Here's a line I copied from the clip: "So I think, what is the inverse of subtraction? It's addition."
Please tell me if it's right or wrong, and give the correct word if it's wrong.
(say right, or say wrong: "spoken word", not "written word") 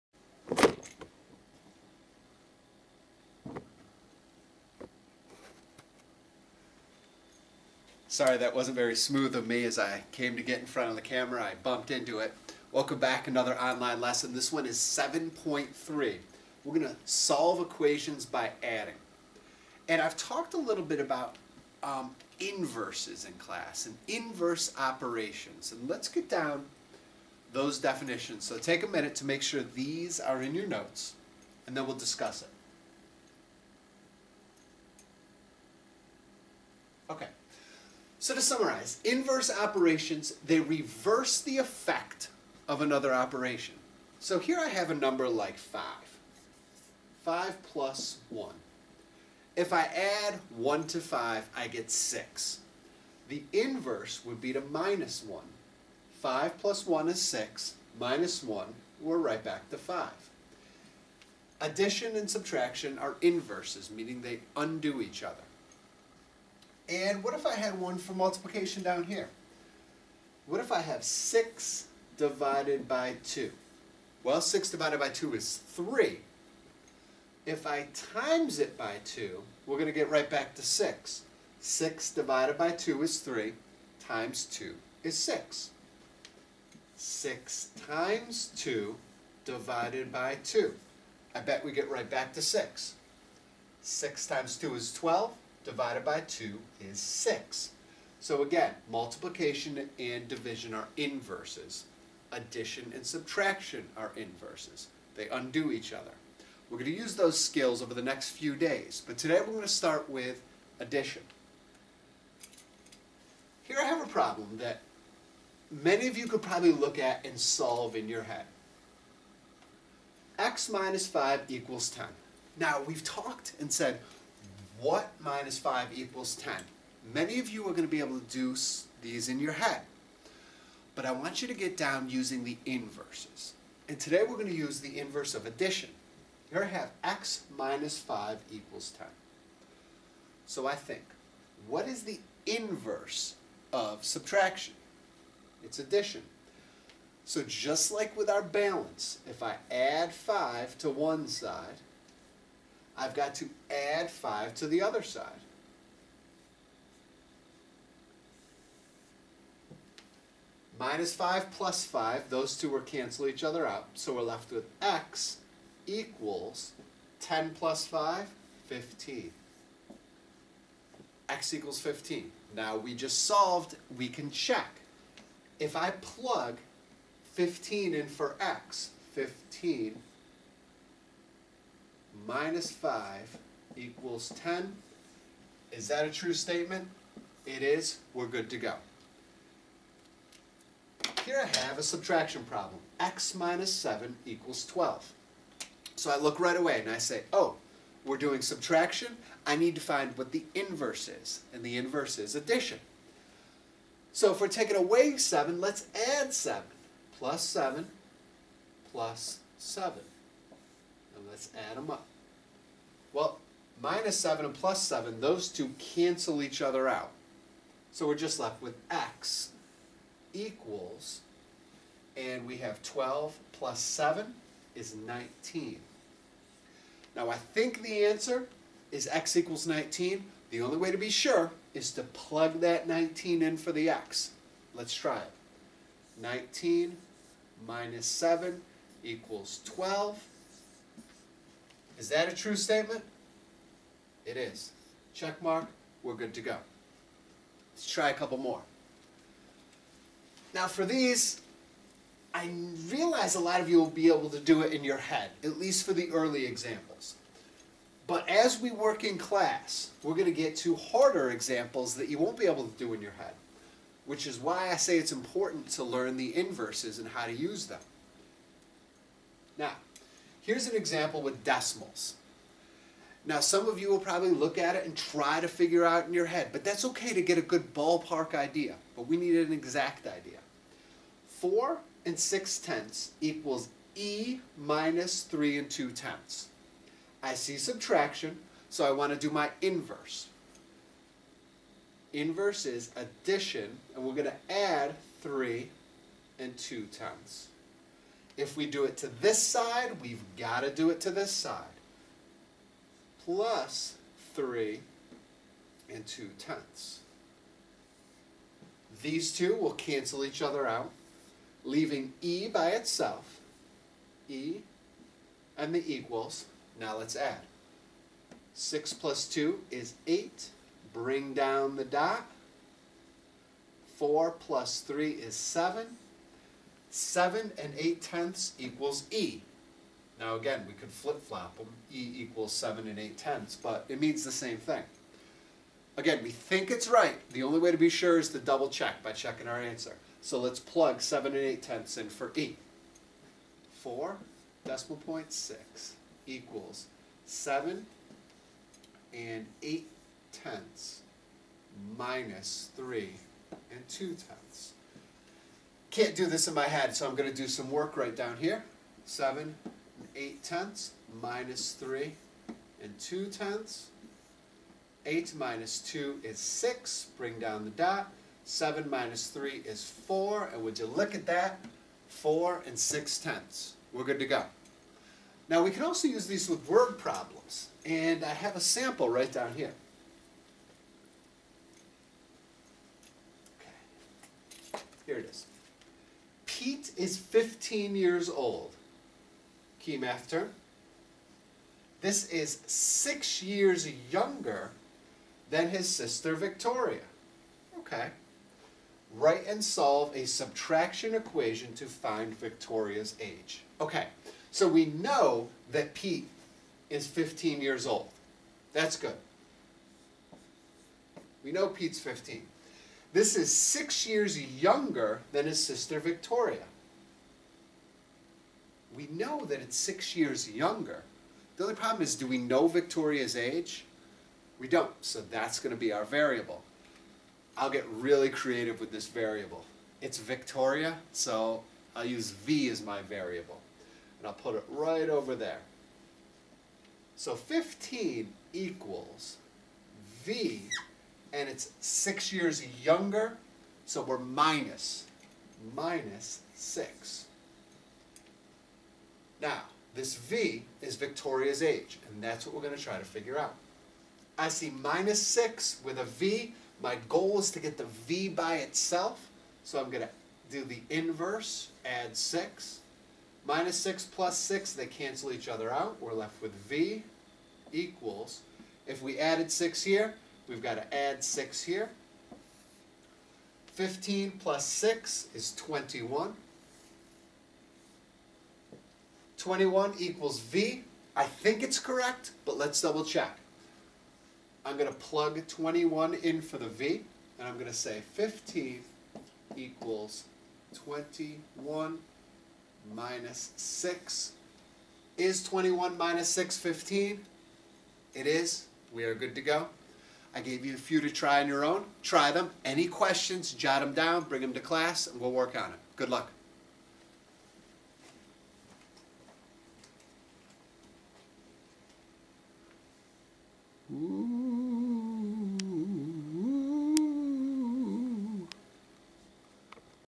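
right.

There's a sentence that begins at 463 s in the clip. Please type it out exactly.
Minus 6 plus 6, they cancel each other out.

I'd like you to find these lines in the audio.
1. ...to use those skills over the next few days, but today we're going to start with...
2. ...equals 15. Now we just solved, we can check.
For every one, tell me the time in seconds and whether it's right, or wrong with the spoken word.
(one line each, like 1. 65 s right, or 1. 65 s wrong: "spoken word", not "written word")
1. 106 s right
2. 171 s right.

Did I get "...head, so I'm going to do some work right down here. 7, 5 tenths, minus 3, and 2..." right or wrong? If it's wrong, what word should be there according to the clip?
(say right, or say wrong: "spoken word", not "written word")
wrong: "8", not "5".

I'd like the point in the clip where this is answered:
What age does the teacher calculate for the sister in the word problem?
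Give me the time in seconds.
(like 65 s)
479 s.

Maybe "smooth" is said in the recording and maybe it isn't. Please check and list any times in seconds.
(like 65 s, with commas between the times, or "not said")
8 s.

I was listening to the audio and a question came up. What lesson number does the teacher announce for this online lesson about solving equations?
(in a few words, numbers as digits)
7.3.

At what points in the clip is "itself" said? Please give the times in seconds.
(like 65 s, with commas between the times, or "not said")
312 s, 458 s.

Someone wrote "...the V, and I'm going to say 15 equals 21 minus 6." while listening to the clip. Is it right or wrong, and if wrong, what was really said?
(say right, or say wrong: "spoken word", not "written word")
right.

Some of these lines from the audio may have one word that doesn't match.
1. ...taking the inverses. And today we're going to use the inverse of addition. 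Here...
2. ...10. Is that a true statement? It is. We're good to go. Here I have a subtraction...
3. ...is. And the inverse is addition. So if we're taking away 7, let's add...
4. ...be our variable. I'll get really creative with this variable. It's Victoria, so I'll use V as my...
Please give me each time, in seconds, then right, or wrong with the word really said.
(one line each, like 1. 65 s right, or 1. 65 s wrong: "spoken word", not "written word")
1. 132 s wrong: "using", not "taking"
2. 184 s right
3. 201 s right
4. 425 s right.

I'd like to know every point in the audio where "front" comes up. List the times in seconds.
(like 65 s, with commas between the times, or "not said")
10 s.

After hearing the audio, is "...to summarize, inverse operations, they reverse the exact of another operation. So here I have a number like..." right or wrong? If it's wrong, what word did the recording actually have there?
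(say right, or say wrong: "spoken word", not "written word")
wrong: "effect", not "exact".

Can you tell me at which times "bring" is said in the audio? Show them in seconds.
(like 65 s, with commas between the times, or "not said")
320 s, 367 s, 504 s.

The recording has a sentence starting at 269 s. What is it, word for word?
Now, Here's an example with decimals.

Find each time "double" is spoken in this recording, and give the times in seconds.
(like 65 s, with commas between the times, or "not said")
338 s, 482 s.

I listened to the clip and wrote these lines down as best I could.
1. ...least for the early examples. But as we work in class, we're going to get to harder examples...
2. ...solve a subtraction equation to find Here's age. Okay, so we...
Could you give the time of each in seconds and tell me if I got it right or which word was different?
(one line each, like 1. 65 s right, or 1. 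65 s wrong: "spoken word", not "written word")
1. 255 s right
2. 399 s wrong: "Victoria", not "Here".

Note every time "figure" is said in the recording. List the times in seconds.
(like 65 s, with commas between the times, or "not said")
275 s, 453 s.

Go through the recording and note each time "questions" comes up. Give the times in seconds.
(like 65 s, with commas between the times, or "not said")
502 s.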